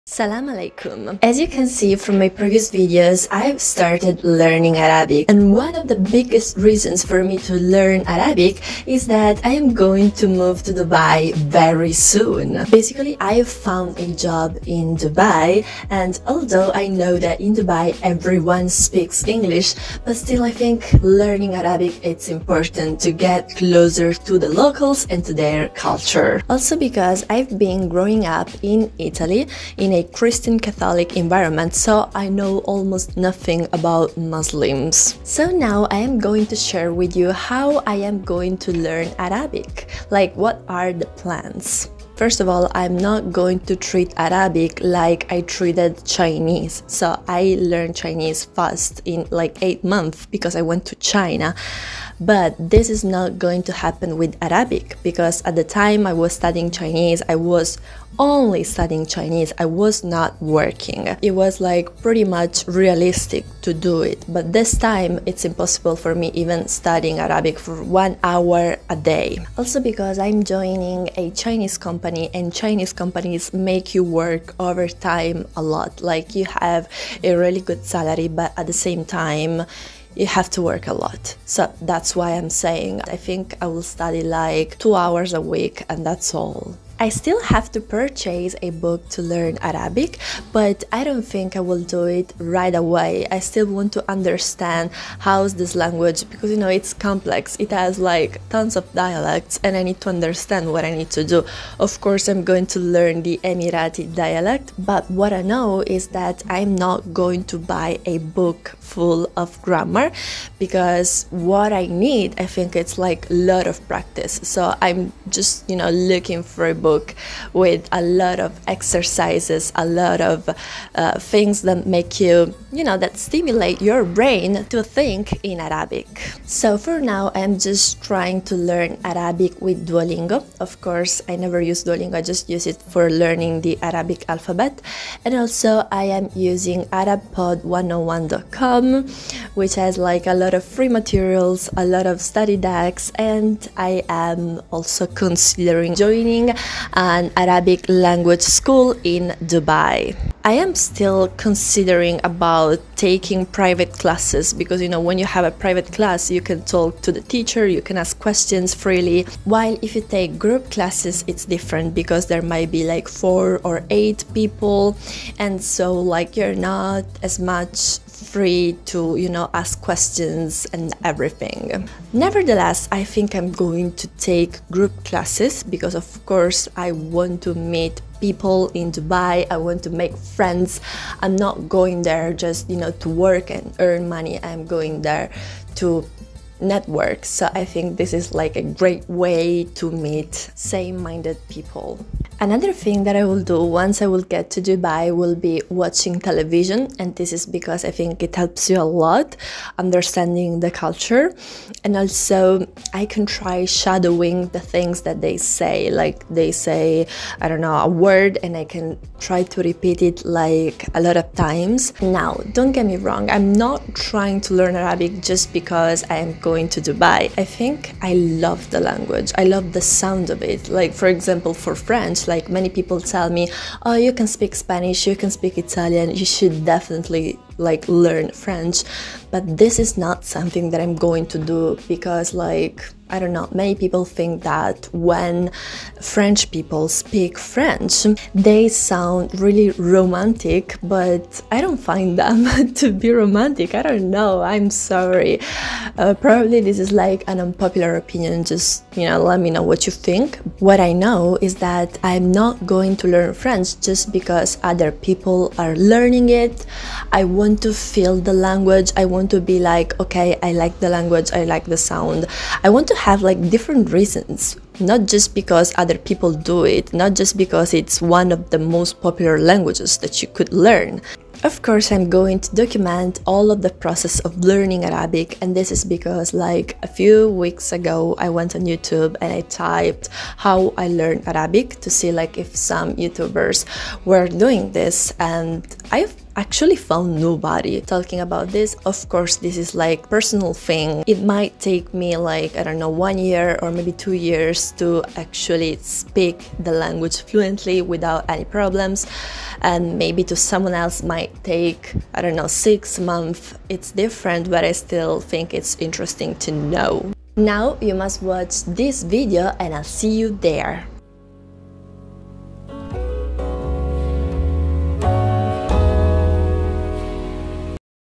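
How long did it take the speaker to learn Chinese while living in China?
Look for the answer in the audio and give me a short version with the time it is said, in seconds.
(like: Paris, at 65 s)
8 months, at 49 s.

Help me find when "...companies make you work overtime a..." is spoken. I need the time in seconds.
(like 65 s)
72 s.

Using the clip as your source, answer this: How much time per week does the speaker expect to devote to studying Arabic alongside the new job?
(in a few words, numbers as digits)
2 hours.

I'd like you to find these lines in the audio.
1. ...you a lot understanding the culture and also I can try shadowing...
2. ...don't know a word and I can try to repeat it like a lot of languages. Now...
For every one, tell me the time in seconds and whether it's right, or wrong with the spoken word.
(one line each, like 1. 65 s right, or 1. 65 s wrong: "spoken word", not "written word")
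1. 198 s right
2. 207 s wrong: "times", not "languages".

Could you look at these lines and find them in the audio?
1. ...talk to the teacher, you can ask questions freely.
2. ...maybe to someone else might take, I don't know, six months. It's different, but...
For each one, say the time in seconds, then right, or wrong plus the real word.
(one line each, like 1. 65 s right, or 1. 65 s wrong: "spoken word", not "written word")
1. 156 s right
2. 299 s right.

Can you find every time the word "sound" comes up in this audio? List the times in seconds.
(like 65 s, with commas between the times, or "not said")
219 s, 238 s, 261 s.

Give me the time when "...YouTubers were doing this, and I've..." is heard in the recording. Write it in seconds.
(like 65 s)
282 s.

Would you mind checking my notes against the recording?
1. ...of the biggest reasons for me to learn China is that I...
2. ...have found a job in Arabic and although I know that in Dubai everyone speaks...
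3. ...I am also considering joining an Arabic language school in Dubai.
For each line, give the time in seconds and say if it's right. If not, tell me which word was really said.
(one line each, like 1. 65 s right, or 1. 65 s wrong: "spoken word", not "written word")
1. 5 s wrong: "Arabic", not "China"
2. 13 s wrong: "Dubai", not "Arabic"
3. 143 s right.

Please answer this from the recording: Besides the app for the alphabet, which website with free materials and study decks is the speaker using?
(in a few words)
ArabPod101.com.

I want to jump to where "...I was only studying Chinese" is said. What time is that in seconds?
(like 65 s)
57 s.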